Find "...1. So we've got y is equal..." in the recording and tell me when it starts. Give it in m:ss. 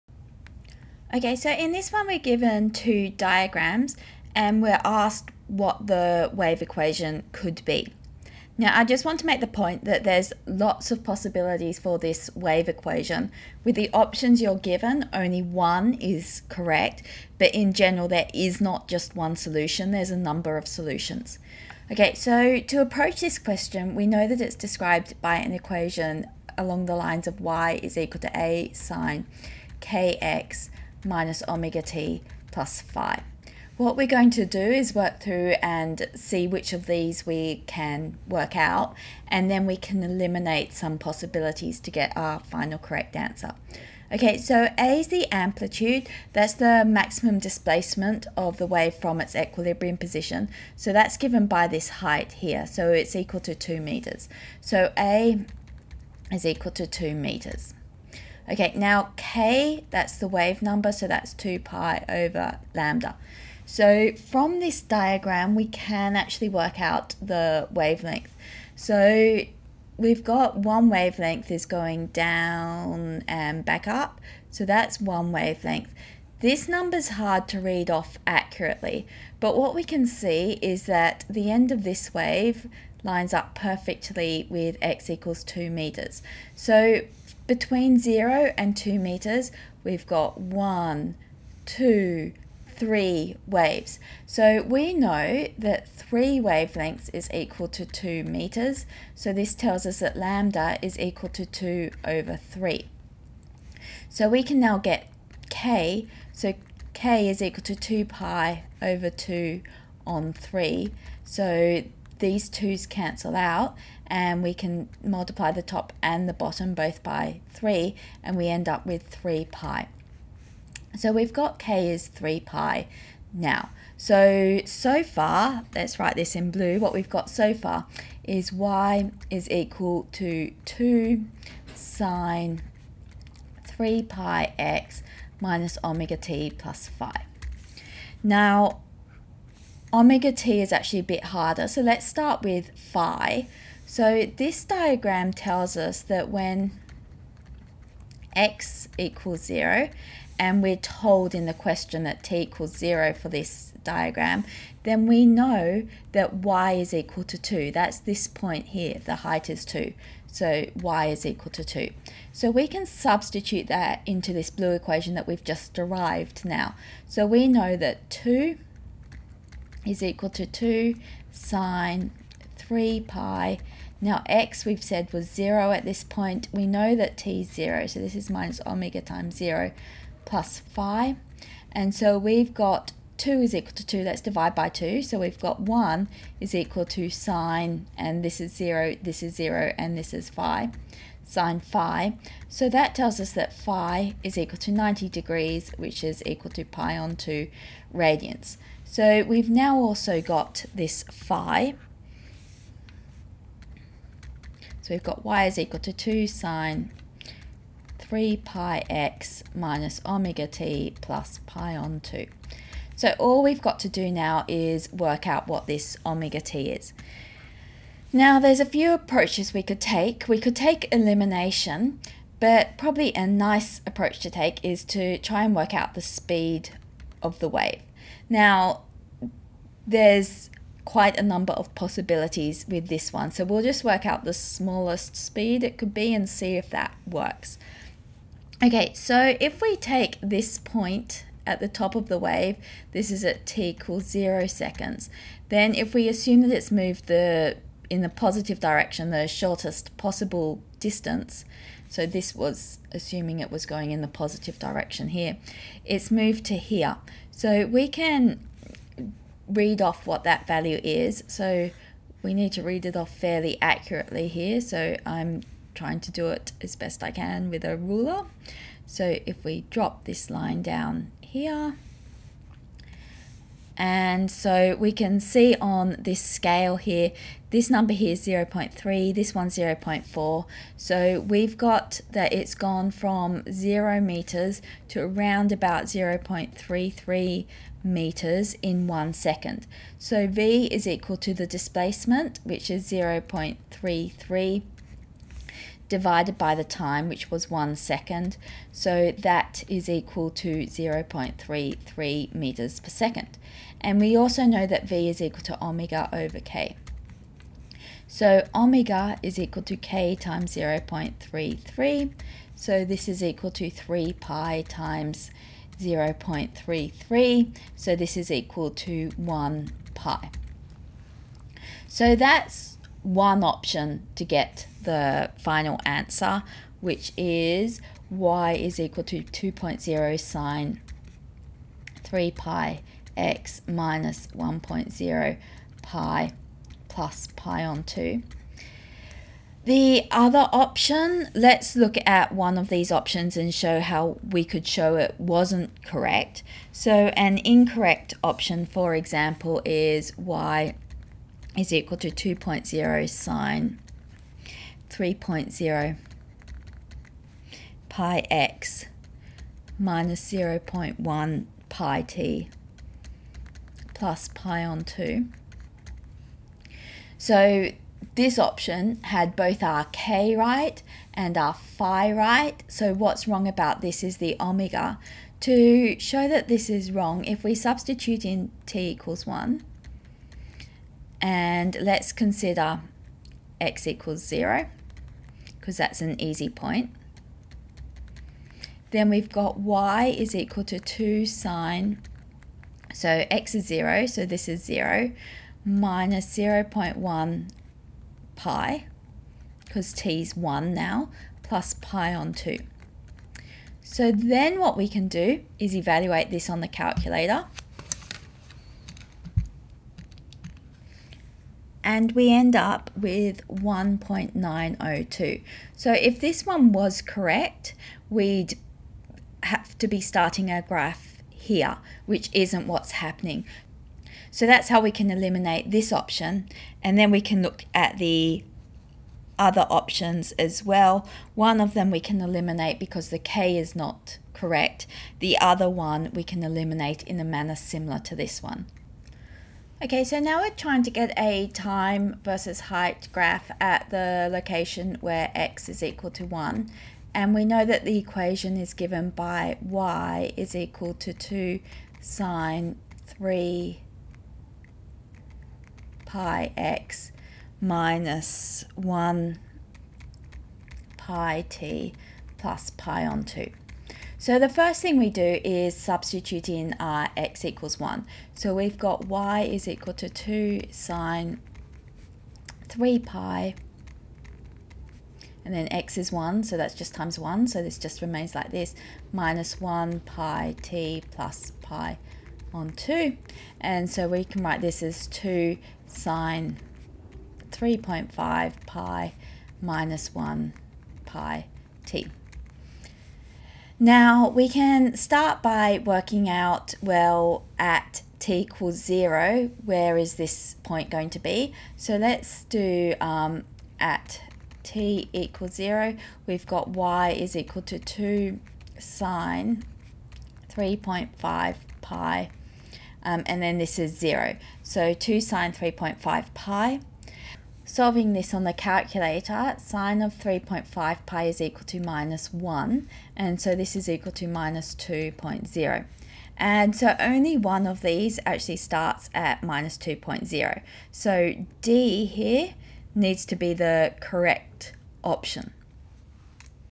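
7:47.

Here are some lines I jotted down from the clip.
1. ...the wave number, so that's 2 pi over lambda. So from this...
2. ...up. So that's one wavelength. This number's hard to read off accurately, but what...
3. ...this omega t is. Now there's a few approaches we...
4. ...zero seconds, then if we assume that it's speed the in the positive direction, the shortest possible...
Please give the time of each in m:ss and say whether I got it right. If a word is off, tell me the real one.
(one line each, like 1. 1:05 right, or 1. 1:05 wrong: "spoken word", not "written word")
1. 1:00 right
2. 1:13 right
3. 3:35 right
4. 4:04 wrong: "moved", not "speed".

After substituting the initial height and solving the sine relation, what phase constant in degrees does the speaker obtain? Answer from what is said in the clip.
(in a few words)
90 degrees.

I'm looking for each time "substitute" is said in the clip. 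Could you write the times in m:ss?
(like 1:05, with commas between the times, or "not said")
2:42, 6:17, 7:45.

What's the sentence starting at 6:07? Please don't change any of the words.
So this option had both our k right and our phi right.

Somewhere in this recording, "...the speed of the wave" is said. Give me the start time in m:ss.
3:45.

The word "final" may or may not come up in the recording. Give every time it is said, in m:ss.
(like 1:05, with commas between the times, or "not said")
0:42, 5:25.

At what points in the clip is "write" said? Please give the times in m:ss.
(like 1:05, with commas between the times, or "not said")
2:05, 8:04.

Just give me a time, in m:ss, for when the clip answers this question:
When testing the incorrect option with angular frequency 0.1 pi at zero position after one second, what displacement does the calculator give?
6:53.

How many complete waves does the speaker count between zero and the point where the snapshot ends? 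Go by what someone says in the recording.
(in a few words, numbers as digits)
3.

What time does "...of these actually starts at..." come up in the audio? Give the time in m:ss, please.
8:47.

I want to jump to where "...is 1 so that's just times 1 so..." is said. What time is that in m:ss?
7:55.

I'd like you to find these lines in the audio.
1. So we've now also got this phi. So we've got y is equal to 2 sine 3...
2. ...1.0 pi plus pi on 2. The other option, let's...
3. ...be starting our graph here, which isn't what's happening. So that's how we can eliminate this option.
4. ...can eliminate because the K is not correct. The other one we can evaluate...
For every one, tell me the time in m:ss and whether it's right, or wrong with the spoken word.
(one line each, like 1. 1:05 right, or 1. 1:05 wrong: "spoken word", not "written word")
1. 3:18 right
2. 5:34 right
3. 6:59 right
4. 7:11 wrong: "eliminate", not "evaluate".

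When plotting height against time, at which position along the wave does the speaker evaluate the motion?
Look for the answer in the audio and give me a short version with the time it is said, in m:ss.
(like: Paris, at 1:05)
x = 1, at 7:25.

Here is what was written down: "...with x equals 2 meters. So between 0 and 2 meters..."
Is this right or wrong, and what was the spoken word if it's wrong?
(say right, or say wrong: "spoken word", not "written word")
right.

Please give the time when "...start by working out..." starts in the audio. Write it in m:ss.
8:14.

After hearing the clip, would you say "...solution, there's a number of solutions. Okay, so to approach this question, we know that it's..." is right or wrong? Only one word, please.
right.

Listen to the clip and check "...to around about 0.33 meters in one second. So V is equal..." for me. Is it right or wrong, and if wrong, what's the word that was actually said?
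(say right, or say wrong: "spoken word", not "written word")
right.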